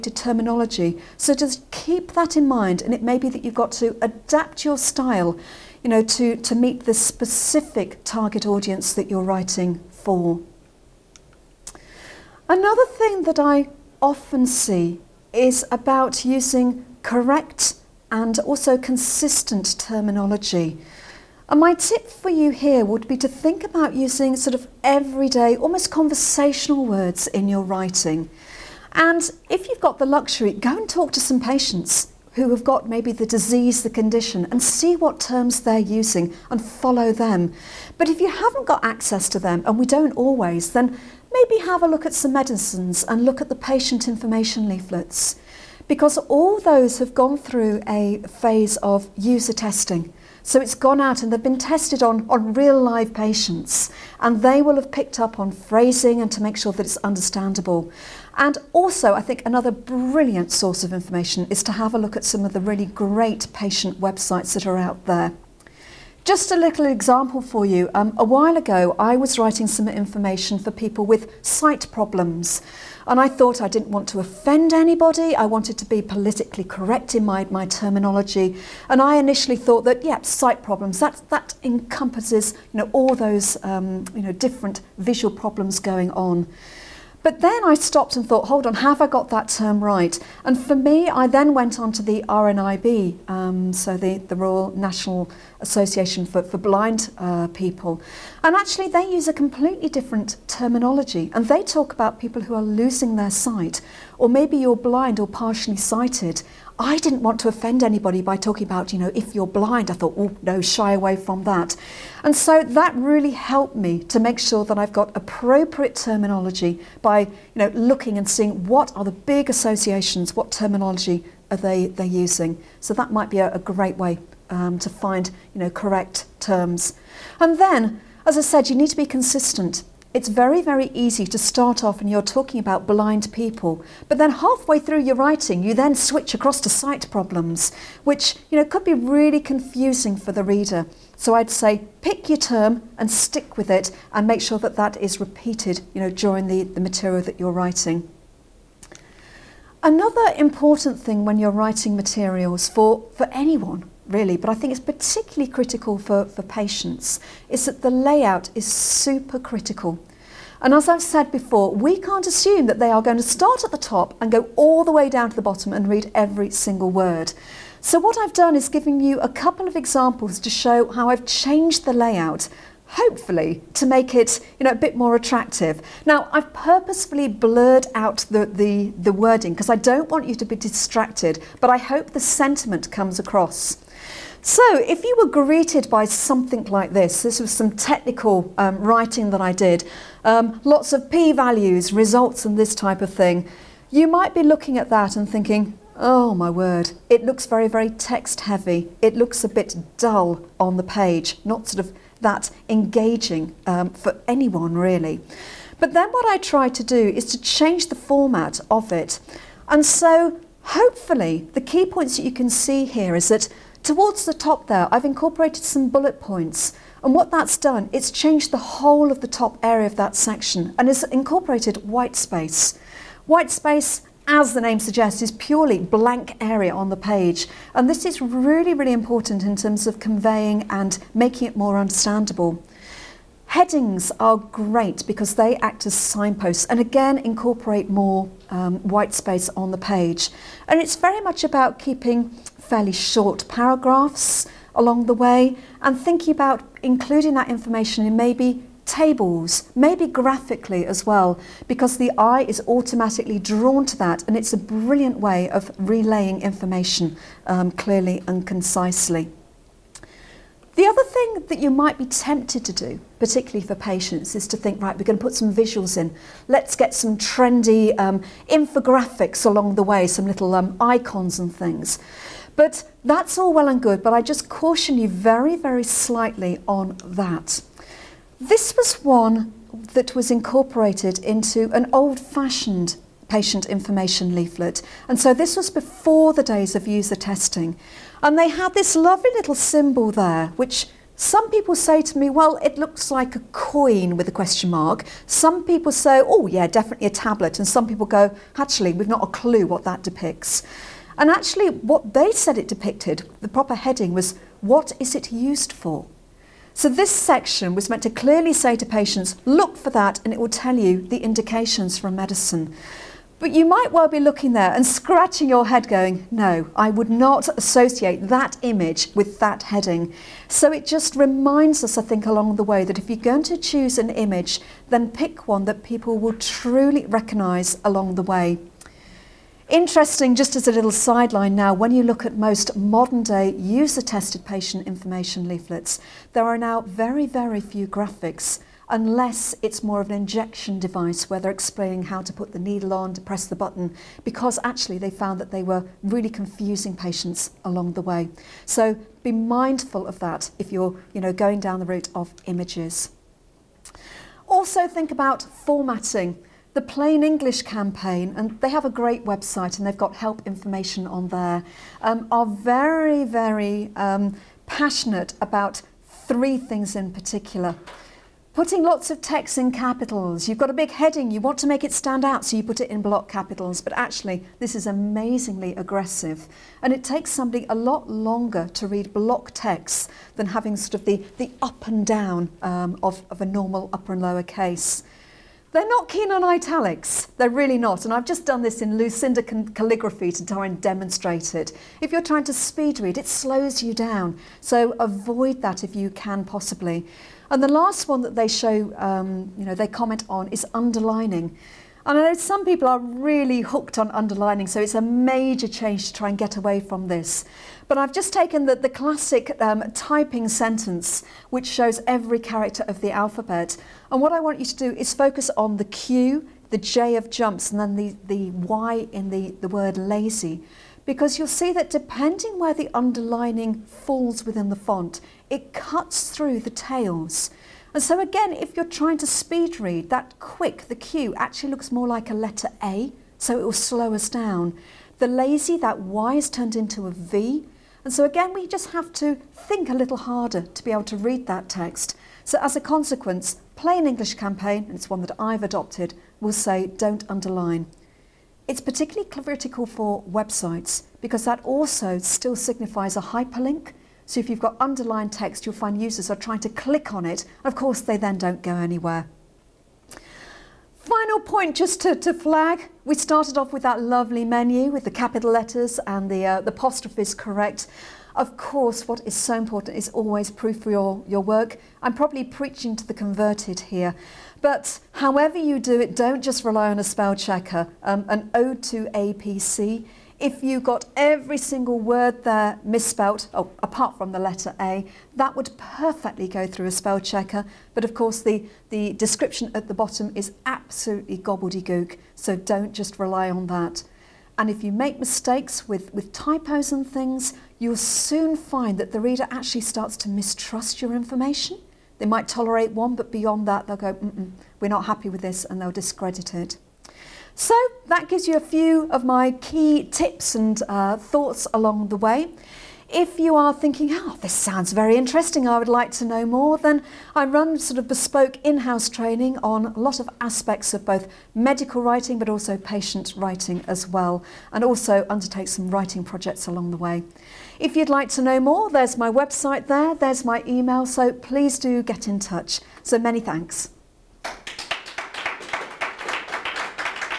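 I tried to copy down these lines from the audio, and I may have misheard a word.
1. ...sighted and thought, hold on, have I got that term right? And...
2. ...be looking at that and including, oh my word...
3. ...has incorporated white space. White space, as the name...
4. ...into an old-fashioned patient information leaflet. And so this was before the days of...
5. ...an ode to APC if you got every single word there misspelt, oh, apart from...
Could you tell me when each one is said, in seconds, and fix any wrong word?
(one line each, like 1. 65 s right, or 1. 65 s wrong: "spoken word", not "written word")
1. 87 s wrong: "stopped", not "sighted"
2. 194 s wrong: "thinking", not "including"
3. 220 s right
4. 281 s right
5. 478 s right.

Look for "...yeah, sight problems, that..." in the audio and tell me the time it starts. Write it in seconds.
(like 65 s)
80 s.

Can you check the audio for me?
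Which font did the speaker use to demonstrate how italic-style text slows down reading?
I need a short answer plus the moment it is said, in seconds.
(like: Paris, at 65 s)
Lucinda calligraphy, at 388 s.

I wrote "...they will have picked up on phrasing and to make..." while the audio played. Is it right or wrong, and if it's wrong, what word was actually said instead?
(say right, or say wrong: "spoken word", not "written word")
right.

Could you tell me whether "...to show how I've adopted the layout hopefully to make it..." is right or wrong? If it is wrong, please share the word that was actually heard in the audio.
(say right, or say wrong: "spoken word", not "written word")
wrong: "changed", not "adopted".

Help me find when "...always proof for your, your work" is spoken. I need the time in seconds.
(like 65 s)
470 s.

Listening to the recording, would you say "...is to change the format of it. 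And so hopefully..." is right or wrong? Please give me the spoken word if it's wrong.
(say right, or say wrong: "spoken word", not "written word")
right.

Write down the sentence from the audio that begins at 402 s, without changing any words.
And I know some people are really hooked on underlining, so it's a major change to try and get away from this.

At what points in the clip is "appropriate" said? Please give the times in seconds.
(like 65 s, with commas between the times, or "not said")
115 s.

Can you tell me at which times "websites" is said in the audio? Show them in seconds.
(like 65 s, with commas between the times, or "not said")
63 s, 359 s, 450 s, 529 s.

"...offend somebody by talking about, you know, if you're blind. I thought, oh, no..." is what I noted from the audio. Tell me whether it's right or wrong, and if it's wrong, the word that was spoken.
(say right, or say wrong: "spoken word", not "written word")
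wrong: "anybody", not "somebody".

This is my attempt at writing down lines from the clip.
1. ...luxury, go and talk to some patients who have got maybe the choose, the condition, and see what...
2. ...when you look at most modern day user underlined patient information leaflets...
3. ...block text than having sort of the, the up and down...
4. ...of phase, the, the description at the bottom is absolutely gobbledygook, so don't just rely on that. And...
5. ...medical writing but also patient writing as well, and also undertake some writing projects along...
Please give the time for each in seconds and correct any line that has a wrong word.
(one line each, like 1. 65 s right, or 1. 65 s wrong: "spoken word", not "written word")
1. 30 s wrong: "disease", not "choose"
2. 331 s wrong: "tested", not "underlined"
3. 379 s right
4. 488 s wrong: "course", not "phase"
5. 521 s right.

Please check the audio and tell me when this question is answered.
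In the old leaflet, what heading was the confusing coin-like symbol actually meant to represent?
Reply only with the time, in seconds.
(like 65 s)
304 s.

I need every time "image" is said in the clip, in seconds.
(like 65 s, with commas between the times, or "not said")
318 s, 324 s, 352 s.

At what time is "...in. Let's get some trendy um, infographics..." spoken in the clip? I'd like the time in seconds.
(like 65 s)
265 s.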